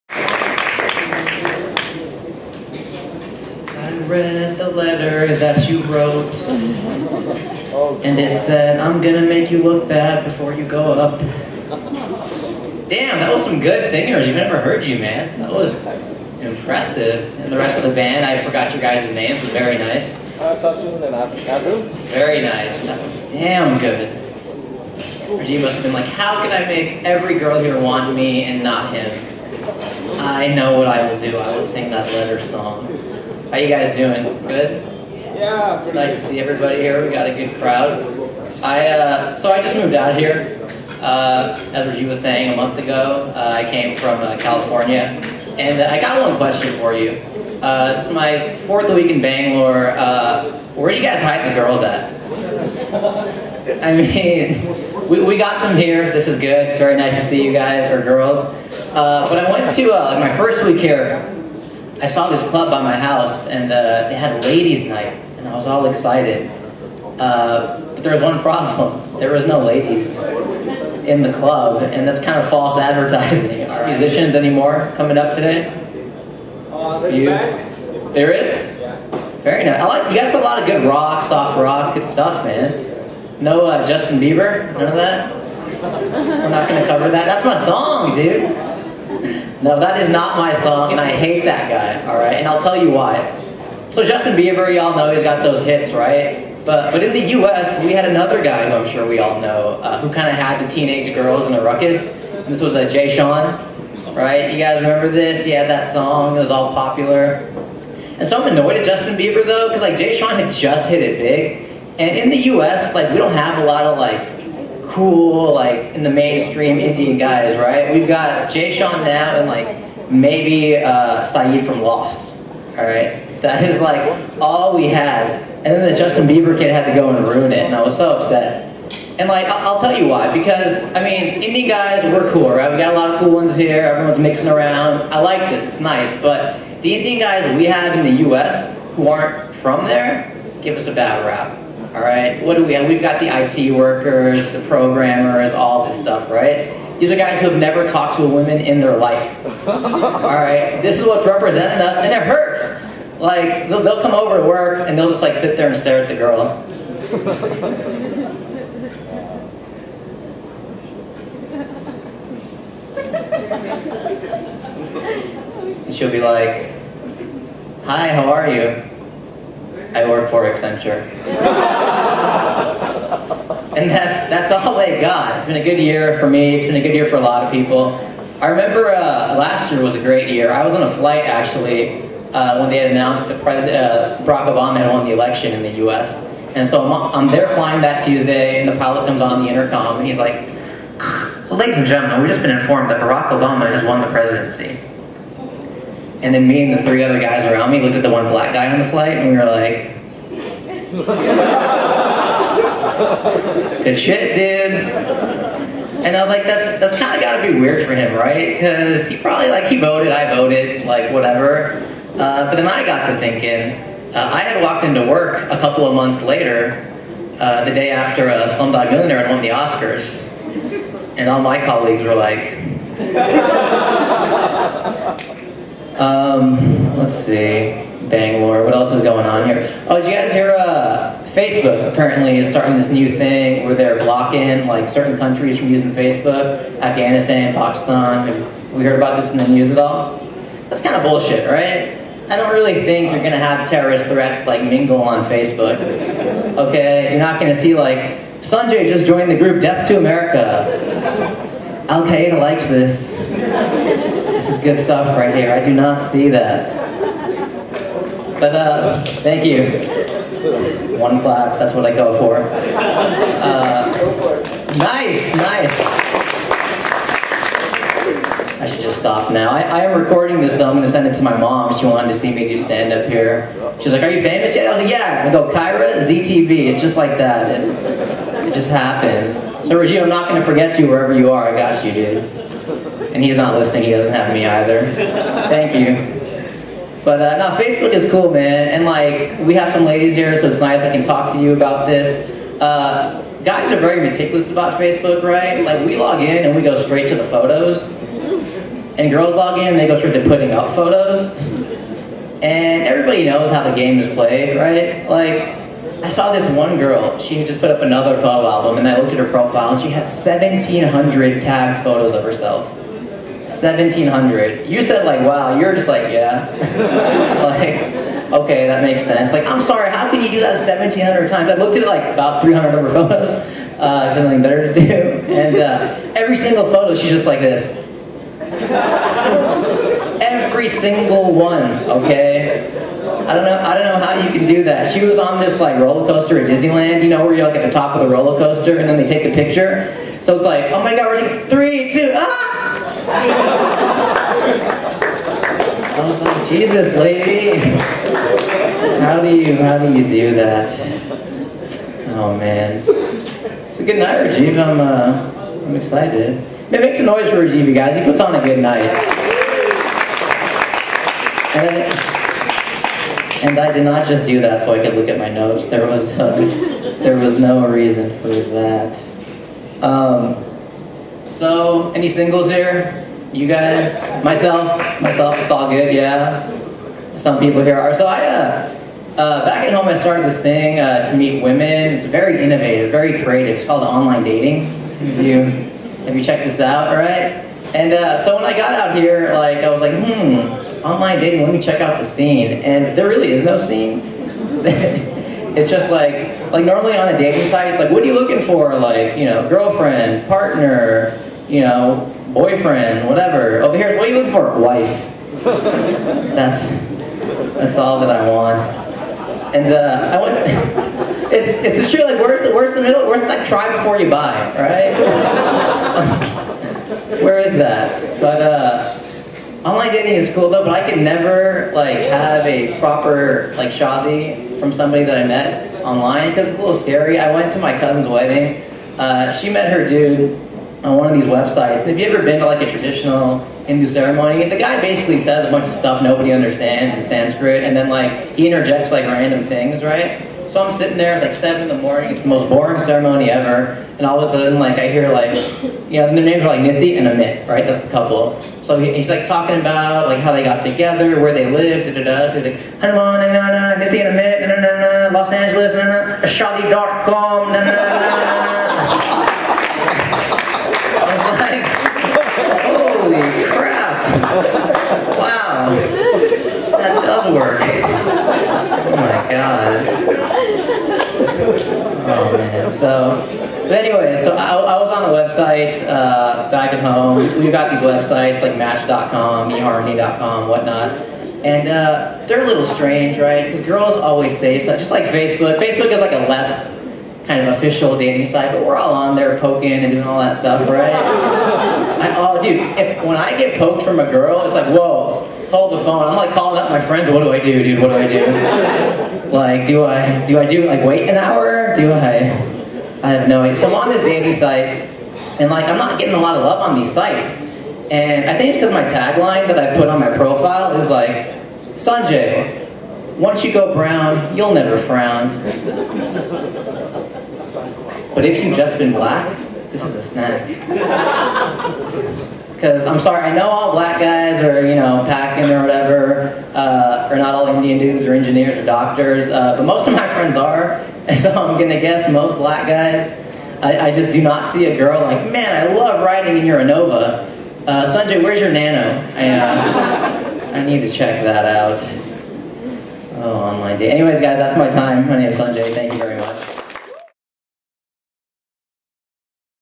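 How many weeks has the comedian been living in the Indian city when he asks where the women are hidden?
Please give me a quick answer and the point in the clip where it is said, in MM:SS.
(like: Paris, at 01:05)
4, at 00:48.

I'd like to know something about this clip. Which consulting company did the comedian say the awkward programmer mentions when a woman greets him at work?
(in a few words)
Accenture.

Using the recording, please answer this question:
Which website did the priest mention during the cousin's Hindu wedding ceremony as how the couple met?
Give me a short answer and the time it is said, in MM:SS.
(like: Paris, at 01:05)
Ashadi.com, at 07:36.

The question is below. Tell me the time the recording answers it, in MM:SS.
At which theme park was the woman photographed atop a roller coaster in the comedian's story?
05:36.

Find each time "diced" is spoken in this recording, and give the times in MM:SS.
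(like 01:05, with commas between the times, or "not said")
not said.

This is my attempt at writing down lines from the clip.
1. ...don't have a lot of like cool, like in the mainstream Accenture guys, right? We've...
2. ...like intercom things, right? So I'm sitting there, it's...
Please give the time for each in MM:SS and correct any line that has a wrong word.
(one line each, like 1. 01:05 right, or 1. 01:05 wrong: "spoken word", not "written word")
1. 01:53 wrong: "Indian", not "Accenture"
2. 07:18 wrong: "random", not "intercom".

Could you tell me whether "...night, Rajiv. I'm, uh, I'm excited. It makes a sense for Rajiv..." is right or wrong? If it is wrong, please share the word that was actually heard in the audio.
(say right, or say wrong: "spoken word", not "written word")
wrong: "noise", not "sense".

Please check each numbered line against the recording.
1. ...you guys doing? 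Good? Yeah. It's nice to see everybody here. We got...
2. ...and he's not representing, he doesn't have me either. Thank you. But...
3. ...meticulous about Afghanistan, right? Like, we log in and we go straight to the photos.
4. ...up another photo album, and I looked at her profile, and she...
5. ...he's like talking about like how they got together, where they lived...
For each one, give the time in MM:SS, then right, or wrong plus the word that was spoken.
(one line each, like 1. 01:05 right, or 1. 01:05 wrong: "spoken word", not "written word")
1. 00:33 right
2. 04:43 wrong: "listening", not "representing"
3. 04:54 wrong: "Facebook", not "Afghanistan"
4. 05:07 right
5. 07:28 right.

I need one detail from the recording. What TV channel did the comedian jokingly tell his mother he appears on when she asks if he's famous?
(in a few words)
Zee TV.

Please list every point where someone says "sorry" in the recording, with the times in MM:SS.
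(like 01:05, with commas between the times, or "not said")
05:19, 08:42.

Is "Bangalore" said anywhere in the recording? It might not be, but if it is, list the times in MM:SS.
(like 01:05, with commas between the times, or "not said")
00:49, 03:48.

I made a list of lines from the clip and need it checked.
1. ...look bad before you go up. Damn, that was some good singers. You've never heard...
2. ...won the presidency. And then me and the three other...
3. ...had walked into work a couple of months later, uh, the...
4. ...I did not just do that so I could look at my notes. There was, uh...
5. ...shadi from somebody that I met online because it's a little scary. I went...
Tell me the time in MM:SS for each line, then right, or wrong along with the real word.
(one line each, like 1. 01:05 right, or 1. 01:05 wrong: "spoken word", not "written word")
1. 00:09 right
2. 03:13 right
3. 03:34 right
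4. 06:03 right
5. 07:03 right.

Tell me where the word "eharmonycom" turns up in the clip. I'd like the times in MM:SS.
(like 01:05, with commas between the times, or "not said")
07:59.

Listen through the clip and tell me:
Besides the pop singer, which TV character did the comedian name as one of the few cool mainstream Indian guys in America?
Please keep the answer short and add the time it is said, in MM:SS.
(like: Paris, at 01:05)
Sayid from Lost, at 02:01.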